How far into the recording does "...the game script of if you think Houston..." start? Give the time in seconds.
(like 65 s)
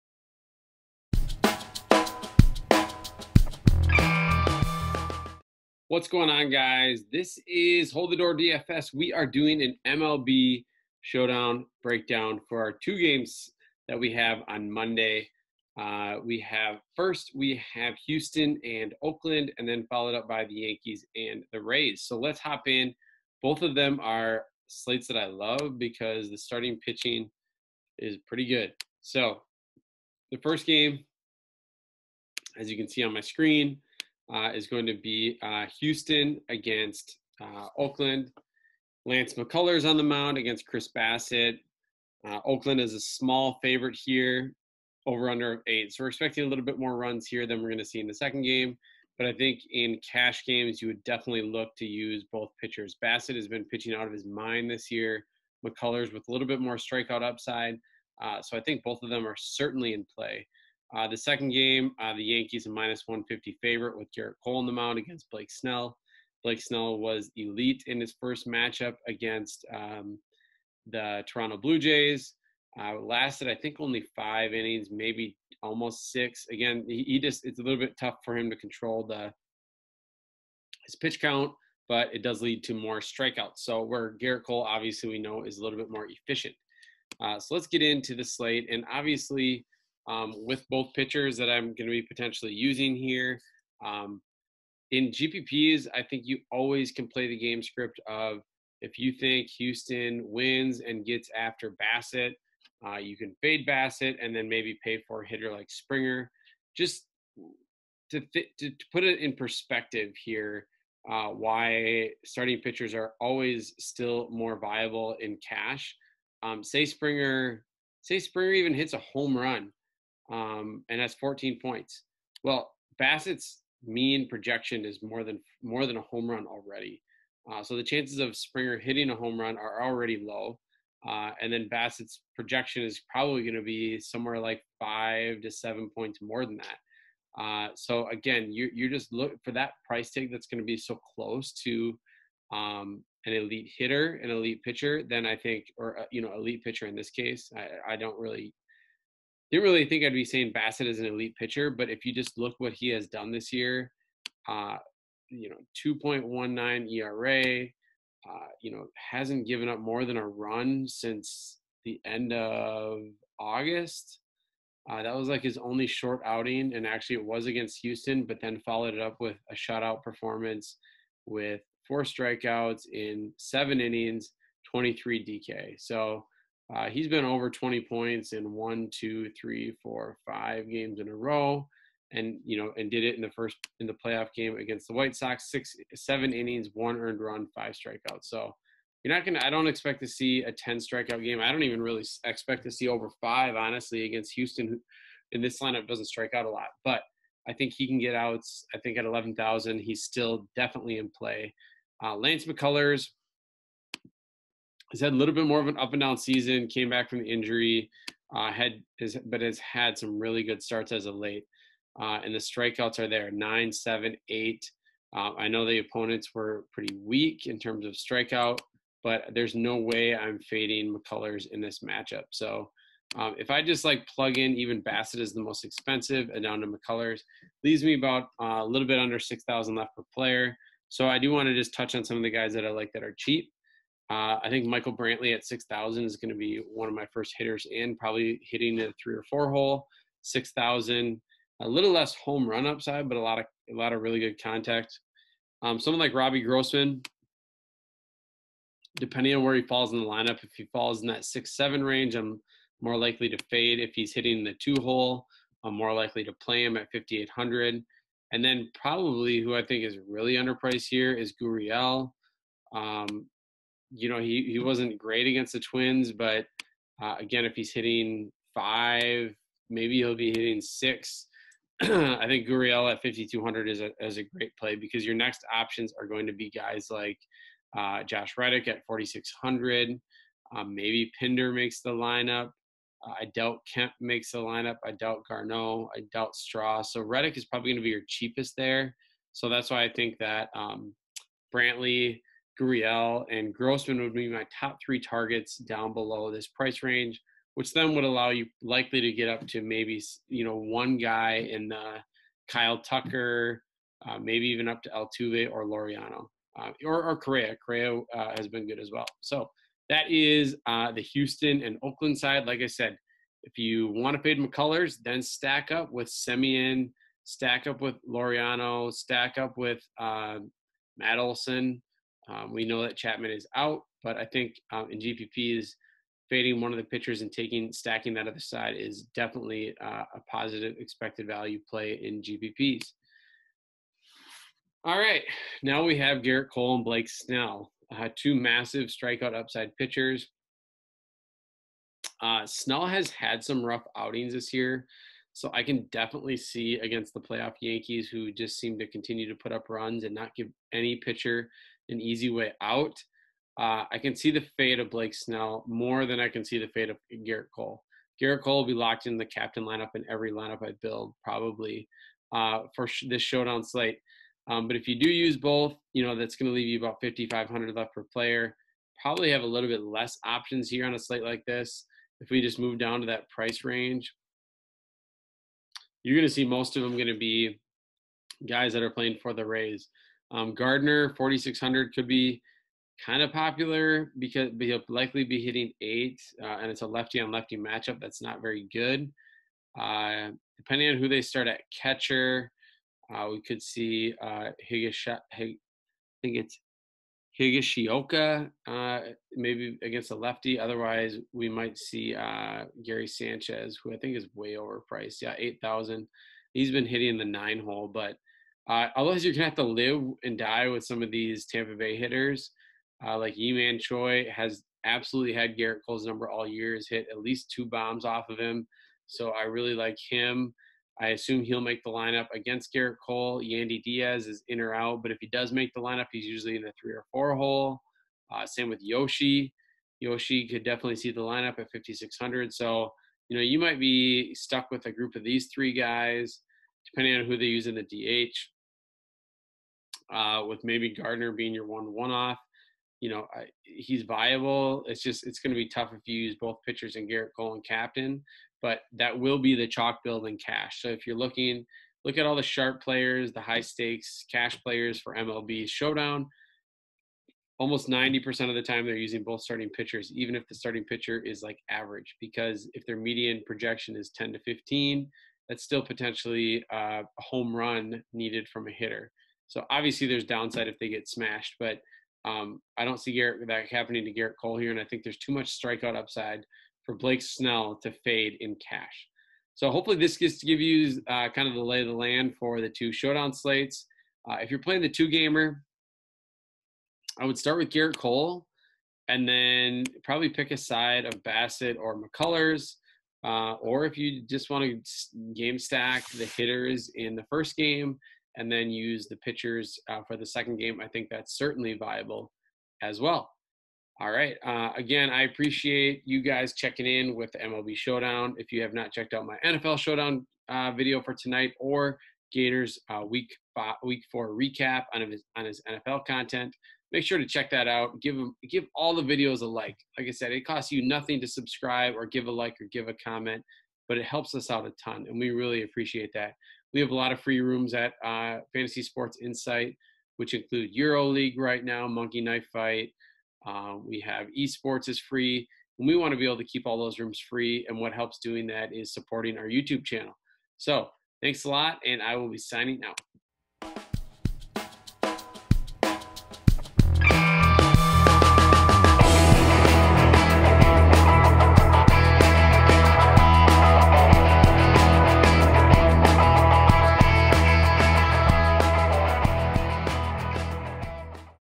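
97 s.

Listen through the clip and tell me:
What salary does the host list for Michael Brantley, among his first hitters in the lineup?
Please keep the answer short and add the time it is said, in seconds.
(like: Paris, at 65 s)
6,000, at 234 s.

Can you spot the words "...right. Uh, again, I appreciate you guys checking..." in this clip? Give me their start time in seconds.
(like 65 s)
504 s.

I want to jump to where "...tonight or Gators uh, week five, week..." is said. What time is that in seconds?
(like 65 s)
511 s.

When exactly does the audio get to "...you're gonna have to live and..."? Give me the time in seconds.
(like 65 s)
409 s.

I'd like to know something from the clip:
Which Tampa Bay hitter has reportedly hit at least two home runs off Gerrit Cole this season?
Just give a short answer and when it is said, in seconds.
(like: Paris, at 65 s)
Ji-Man Choi, at 413 s.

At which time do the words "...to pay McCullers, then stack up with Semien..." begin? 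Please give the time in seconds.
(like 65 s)
314 s.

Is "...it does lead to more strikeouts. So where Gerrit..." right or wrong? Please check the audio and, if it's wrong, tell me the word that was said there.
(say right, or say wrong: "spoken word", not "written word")
right.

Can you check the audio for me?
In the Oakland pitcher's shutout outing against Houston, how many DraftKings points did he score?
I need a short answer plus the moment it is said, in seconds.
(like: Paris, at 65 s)
23, at 174 s.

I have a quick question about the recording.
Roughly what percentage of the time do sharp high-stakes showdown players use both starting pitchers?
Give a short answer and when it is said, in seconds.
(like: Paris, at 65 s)
90%, at 457 s.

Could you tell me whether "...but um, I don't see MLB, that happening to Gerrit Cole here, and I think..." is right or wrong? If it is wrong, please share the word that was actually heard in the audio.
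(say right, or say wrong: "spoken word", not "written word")
wrong: "Gerrit", not "MLB".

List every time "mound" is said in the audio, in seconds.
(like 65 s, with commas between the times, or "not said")
40 s, 64 s.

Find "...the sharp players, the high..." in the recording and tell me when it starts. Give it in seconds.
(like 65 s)
452 s.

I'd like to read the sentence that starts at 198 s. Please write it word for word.
I think at 11,000, he's still definitely in play.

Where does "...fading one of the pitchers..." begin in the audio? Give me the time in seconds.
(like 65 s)
326 s.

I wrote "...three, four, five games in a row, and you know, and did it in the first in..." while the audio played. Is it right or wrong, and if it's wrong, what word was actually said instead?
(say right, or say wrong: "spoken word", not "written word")
right.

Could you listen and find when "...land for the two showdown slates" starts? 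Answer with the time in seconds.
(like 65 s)
481 s.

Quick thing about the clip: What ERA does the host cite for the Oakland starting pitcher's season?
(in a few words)
2.19.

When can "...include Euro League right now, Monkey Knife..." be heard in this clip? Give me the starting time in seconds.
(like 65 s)
530 s.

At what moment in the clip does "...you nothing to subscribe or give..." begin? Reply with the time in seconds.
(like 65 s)
520 s.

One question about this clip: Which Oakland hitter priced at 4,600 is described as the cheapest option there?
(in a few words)
Josh Reddick.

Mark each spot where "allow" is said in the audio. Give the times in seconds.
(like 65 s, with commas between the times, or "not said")
298 s.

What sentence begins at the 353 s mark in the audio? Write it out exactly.
Uh, I can see the fate of Blake Snell more than I can see the fate of Gerrit Cole.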